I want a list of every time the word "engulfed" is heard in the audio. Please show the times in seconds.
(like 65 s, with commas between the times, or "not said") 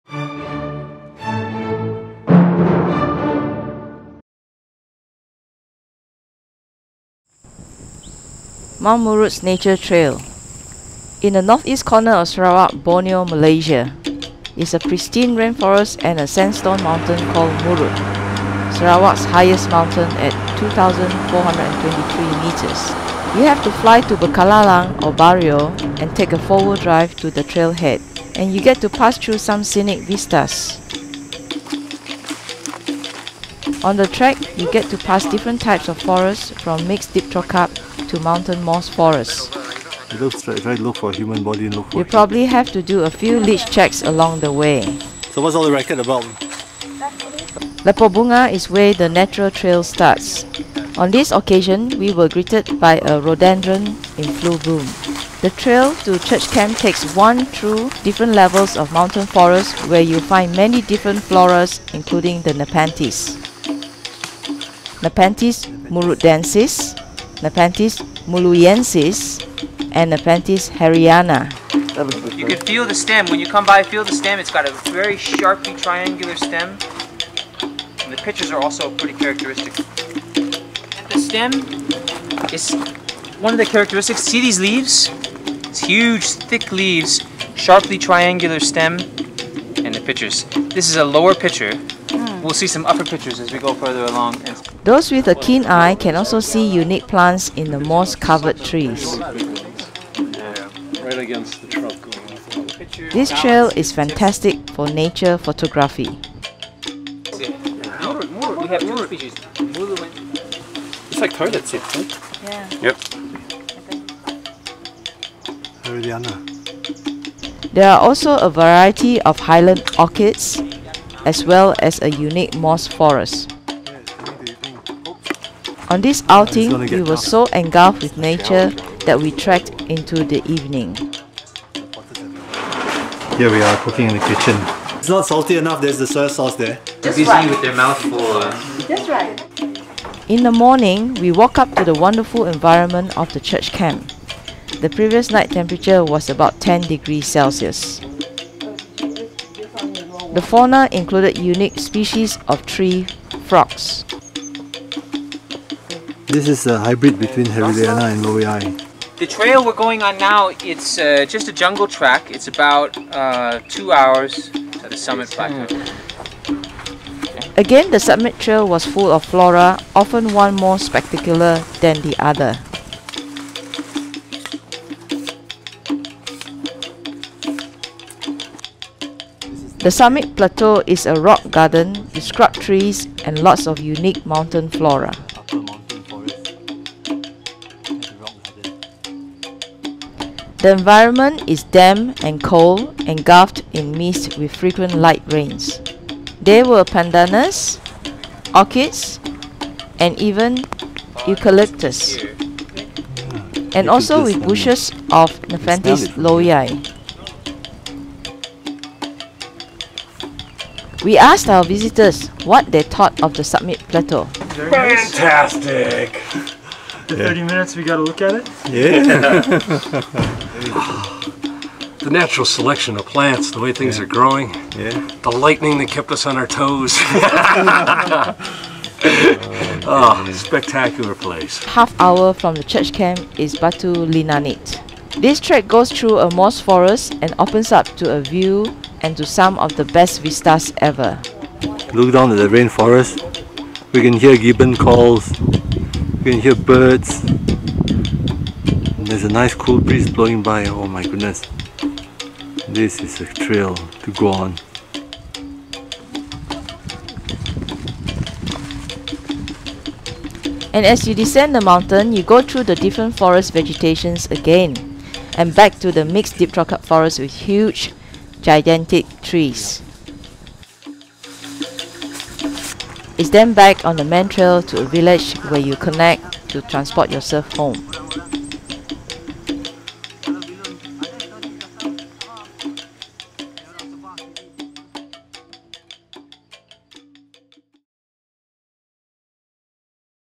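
127 s, 193 s.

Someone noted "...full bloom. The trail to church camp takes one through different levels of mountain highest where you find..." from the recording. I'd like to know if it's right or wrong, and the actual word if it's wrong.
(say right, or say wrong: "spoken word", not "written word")
wrong: "forest", not "highest".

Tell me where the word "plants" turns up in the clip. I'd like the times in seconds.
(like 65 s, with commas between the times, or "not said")
97 s, 223 s.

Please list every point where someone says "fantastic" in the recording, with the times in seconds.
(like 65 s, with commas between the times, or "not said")
103 s, 214 s.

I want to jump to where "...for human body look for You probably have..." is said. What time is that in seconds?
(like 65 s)
40 s.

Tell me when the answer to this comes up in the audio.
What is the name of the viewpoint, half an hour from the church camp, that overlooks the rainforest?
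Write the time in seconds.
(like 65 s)
233 s.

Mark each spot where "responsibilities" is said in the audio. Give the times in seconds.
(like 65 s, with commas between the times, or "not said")
not said.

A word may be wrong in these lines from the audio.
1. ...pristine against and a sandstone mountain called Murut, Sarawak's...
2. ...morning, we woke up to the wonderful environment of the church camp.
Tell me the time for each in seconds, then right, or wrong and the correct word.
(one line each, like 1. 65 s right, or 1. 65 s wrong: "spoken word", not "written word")
1. 14 s wrong: "rainforest", not "against"
2. 140 s right.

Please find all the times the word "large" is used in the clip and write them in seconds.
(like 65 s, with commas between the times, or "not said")
not said.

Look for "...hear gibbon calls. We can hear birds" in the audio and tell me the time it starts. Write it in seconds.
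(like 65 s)
244 s.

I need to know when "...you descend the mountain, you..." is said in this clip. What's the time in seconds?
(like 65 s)
261 s.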